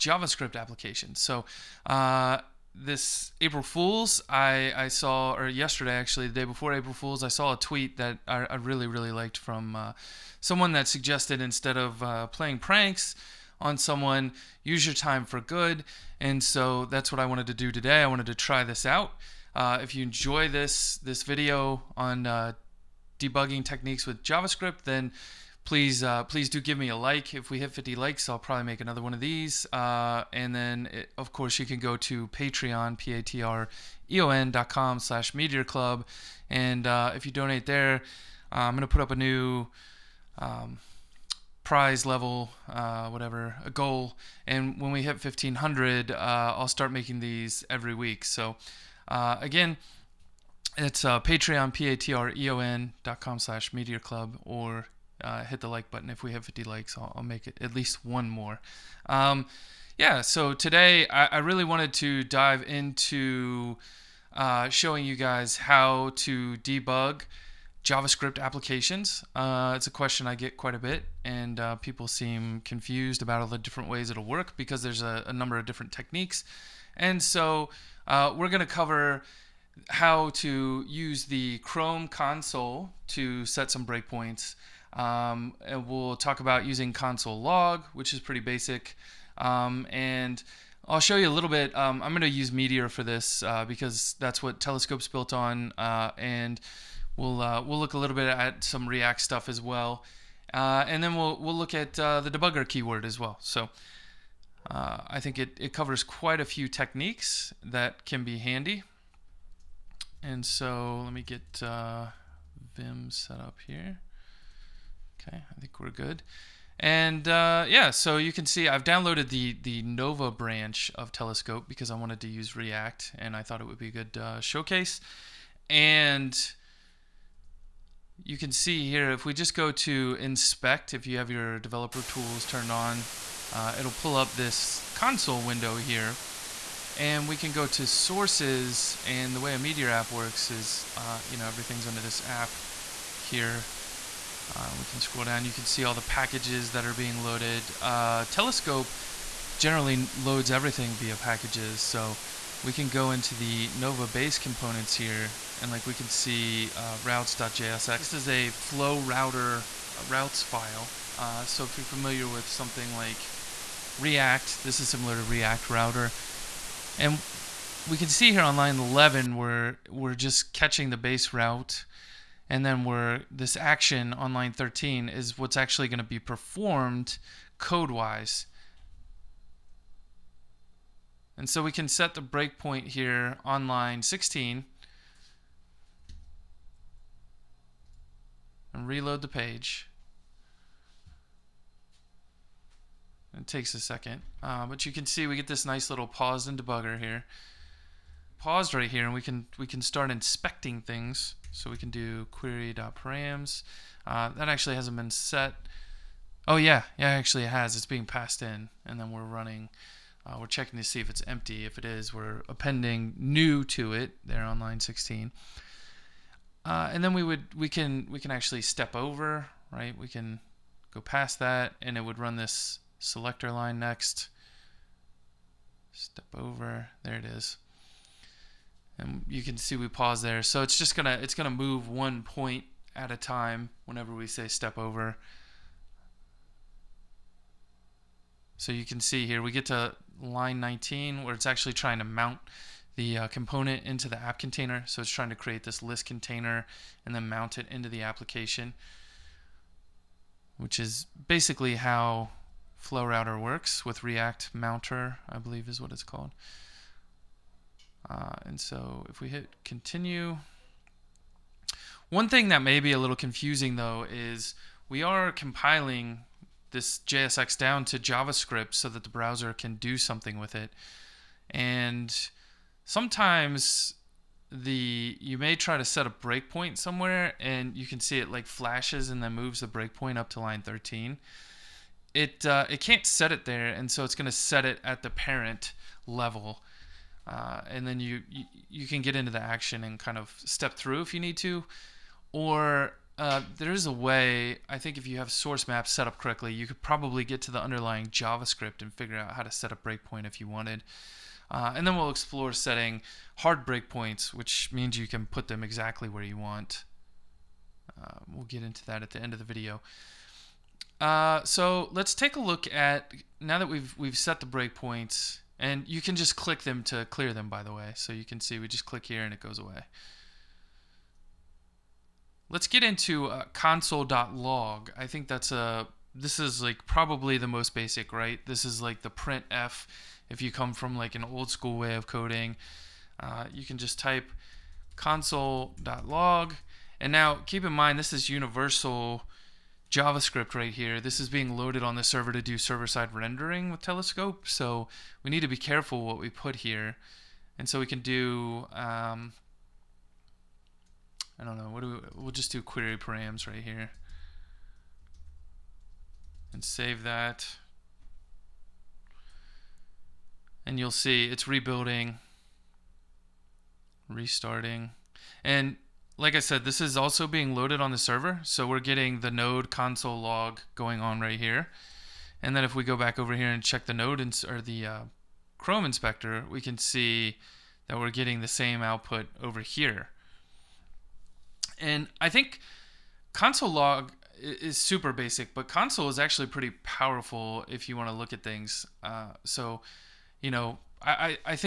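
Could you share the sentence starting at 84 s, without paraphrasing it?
Um, and we'll talk about using console log, which is pretty basic.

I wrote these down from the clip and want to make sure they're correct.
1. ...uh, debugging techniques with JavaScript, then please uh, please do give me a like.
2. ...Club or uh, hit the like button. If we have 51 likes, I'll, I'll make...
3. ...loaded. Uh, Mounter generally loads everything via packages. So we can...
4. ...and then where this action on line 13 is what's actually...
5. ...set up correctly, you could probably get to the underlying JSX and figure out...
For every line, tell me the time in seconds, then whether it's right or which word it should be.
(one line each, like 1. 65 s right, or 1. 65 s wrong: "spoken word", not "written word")
1. 22 s right
2. 53 s wrong: "50", not "51"
3. 147 s wrong: "Telescope", not "Mounter"
4. 172 s right
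5. 295 s wrong: "JavaScript", not "JSX".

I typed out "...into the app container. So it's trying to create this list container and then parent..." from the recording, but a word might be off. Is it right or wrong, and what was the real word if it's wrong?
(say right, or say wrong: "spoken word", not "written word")
wrong: "mount", not "parent".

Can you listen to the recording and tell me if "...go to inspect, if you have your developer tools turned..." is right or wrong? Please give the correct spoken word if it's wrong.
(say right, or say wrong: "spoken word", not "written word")
right.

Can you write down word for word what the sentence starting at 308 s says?
Uh, we'll get into that at the end of the video.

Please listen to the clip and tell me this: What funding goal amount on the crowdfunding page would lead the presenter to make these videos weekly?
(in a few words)
1,500.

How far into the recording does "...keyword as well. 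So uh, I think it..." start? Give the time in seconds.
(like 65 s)
102 s.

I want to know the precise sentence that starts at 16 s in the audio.
And so that's what I wanted to do today.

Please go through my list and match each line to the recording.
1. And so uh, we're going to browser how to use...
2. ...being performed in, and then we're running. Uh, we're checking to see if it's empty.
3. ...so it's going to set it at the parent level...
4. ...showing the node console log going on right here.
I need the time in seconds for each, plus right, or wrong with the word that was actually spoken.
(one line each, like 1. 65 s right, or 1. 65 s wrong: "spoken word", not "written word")
1. 76 s wrong: "cover", not "browser"
2. 207 s wrong: "passed", not "performed"
3. 283 s right
4. 368 s wrong: "getting", not "showing".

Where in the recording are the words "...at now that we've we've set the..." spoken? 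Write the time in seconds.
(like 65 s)
312 s.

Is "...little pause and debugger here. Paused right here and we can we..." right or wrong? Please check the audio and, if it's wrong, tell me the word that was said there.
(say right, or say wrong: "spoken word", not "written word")
right.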